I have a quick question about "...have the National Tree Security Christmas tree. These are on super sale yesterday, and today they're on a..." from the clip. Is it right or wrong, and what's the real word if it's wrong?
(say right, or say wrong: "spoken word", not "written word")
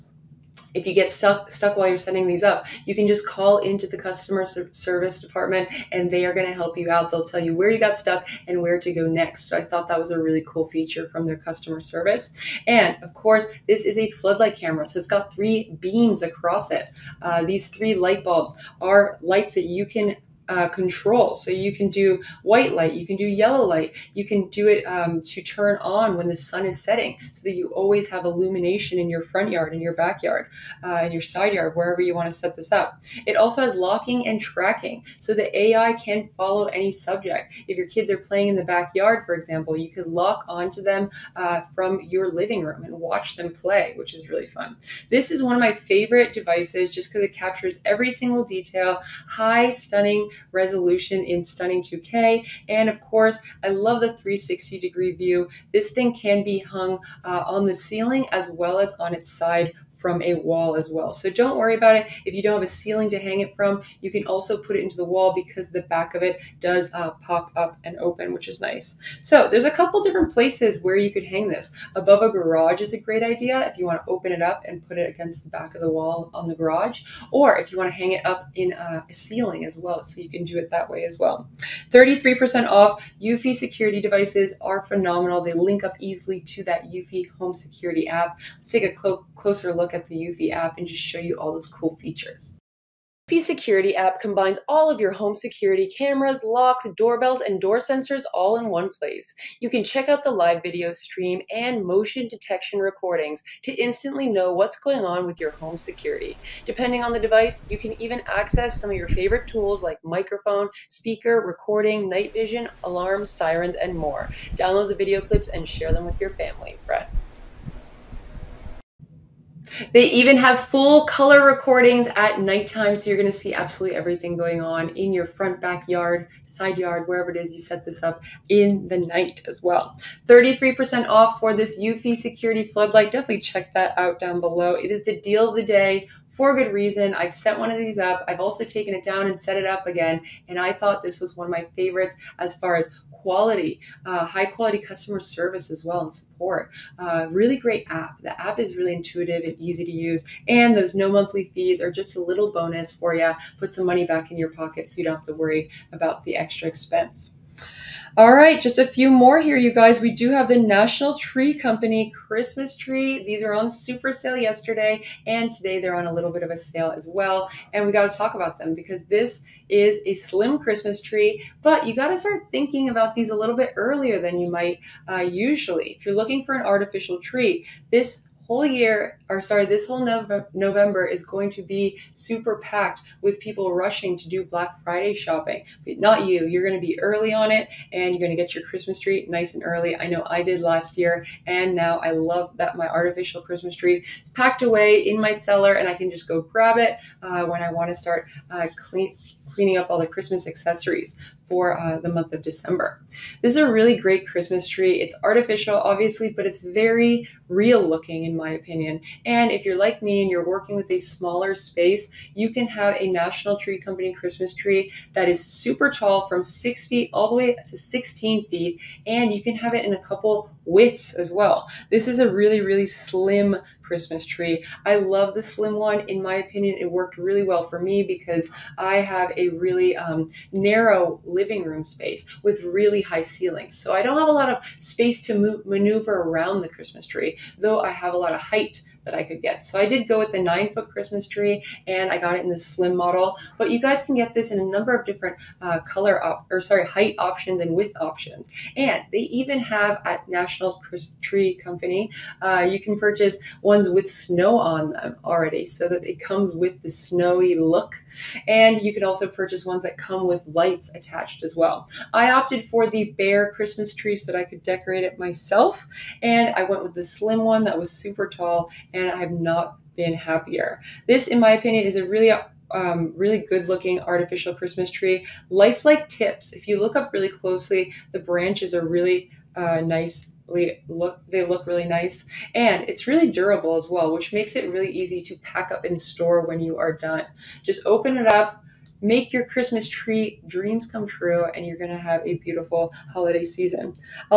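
wrong: "Company", not "Security".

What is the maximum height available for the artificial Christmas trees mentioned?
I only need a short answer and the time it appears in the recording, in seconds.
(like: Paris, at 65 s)
16 feet, at 217 s.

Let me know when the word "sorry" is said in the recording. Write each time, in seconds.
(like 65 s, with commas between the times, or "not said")
179 s, 246 s.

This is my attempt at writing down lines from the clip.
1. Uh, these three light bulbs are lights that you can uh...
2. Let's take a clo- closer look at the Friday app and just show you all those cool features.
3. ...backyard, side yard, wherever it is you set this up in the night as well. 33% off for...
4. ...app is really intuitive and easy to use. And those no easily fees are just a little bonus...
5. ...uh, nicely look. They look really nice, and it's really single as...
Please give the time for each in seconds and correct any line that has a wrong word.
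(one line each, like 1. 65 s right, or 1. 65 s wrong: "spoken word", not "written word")
1. 17 s right
2. 88 s wrong: "Eufy", not "Friday"
3. 125 s right
4. 148 s wrong: "monthly", not "easily"
5. 279 s wrong: "durable", not "single".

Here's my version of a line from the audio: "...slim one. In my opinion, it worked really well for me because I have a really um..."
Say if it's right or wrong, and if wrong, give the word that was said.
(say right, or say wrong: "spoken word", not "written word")
right.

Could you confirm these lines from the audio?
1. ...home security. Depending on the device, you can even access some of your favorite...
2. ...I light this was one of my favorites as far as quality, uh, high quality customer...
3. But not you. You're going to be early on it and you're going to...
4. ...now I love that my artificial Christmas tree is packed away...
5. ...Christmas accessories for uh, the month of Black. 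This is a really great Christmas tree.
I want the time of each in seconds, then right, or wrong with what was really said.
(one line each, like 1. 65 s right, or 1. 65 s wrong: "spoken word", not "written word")
1. 105 s right
2. 140 s wrong: "thought", not "light"
3. 185 s right
4. 191 s right
5. 200 s wrong: "December", not "Black".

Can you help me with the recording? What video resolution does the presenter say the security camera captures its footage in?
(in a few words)
2K.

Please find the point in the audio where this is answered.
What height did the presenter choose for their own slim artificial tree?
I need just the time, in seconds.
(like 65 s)
240 s.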